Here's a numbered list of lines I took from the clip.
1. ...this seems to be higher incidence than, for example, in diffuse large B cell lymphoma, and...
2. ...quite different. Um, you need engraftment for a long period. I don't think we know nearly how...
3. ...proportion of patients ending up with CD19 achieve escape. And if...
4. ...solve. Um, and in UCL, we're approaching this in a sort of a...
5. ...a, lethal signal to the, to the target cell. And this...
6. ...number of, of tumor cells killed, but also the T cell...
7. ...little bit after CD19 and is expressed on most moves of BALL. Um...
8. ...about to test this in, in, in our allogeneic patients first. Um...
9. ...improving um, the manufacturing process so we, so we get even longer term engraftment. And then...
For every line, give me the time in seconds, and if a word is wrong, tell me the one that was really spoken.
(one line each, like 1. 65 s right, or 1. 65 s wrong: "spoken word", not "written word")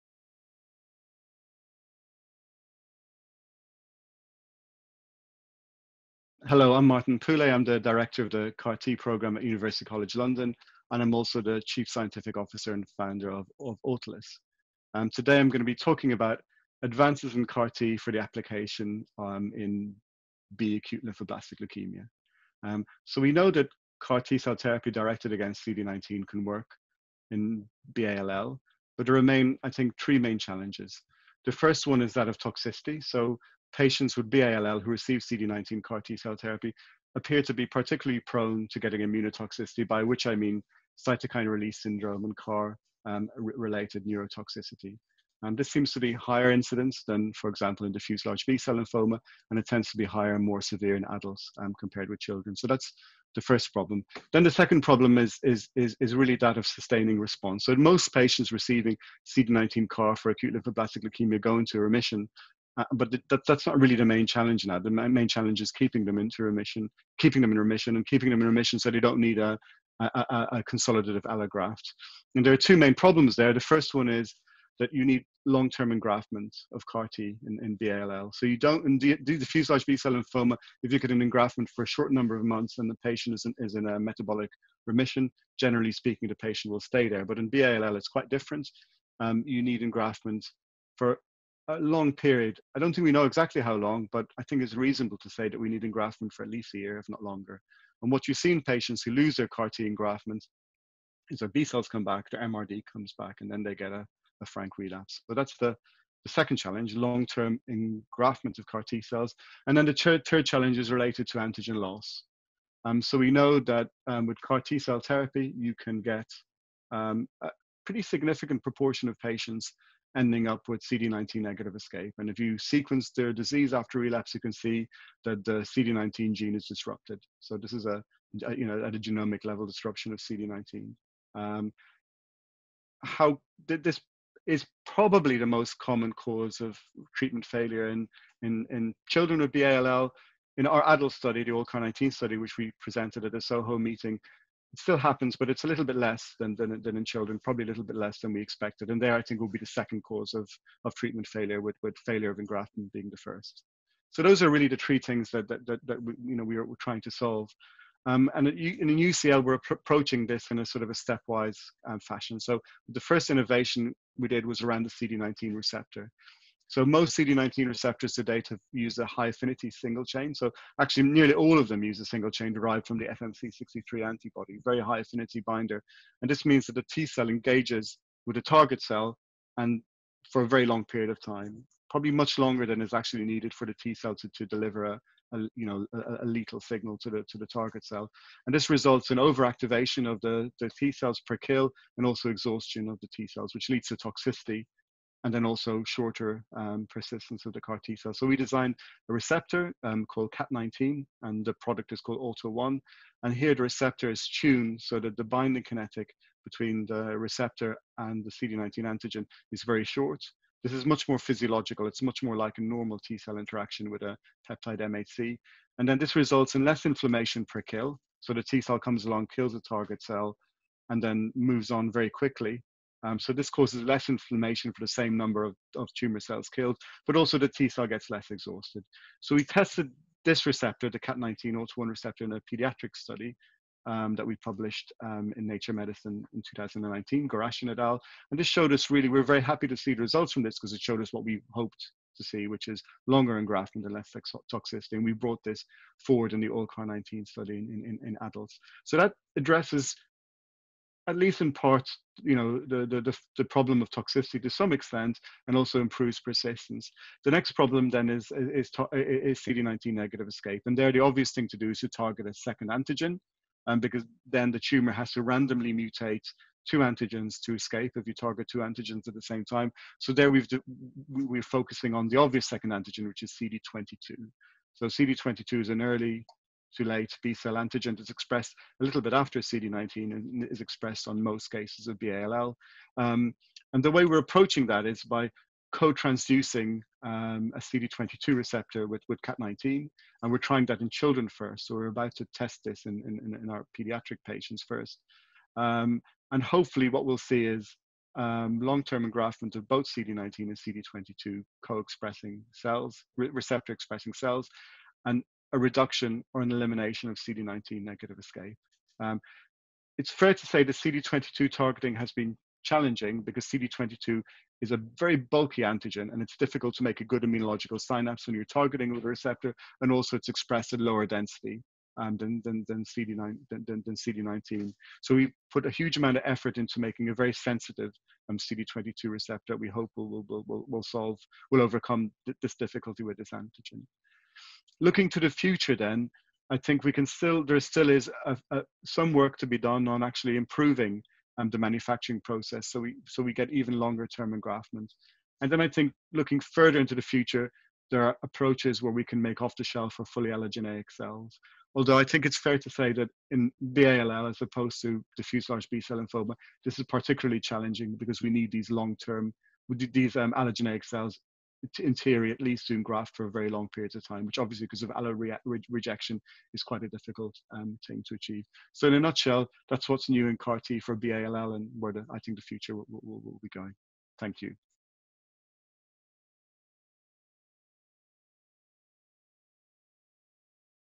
1. 45 s right
2. 88 s wrong: "exactly", not "nearly"
3. 118 s wrong: "negative", not "achieve"
4. 157 s right
5. 186 s right
6. 225 s right
7. 278 s wrong: "cases", not "moves"
8. 291 s wrong: "pediatric", not "allogeneic"
9. 340 s right.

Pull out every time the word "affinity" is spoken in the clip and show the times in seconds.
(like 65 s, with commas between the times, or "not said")
169 s, 174 s.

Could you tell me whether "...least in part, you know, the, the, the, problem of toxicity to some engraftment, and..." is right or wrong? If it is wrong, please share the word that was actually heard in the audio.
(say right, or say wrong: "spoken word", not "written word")
wrong: "extent", not "engraftment".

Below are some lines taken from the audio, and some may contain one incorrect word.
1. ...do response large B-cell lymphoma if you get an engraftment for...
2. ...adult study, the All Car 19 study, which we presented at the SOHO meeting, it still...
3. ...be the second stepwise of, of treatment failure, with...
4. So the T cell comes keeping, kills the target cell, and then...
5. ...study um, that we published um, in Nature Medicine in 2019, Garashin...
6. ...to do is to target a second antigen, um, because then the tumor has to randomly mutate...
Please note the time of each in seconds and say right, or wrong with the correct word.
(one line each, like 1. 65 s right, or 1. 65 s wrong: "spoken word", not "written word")
1. 78 s wrong: "diffuse", not "response"
2. 140 s right
3. 149 s wrong: "cause", not "stepwise"
4. 218 s wrong: "along", not "keeping"
5. 232 s right
6. 261 s right.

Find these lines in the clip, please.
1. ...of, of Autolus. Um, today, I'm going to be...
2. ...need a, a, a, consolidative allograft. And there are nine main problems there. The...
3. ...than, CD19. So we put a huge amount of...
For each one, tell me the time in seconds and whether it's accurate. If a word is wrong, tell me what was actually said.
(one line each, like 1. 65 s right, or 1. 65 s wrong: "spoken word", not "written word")
1. 13 s right
2. 69 s wrong: "two", not "nine"
3. 323 s right.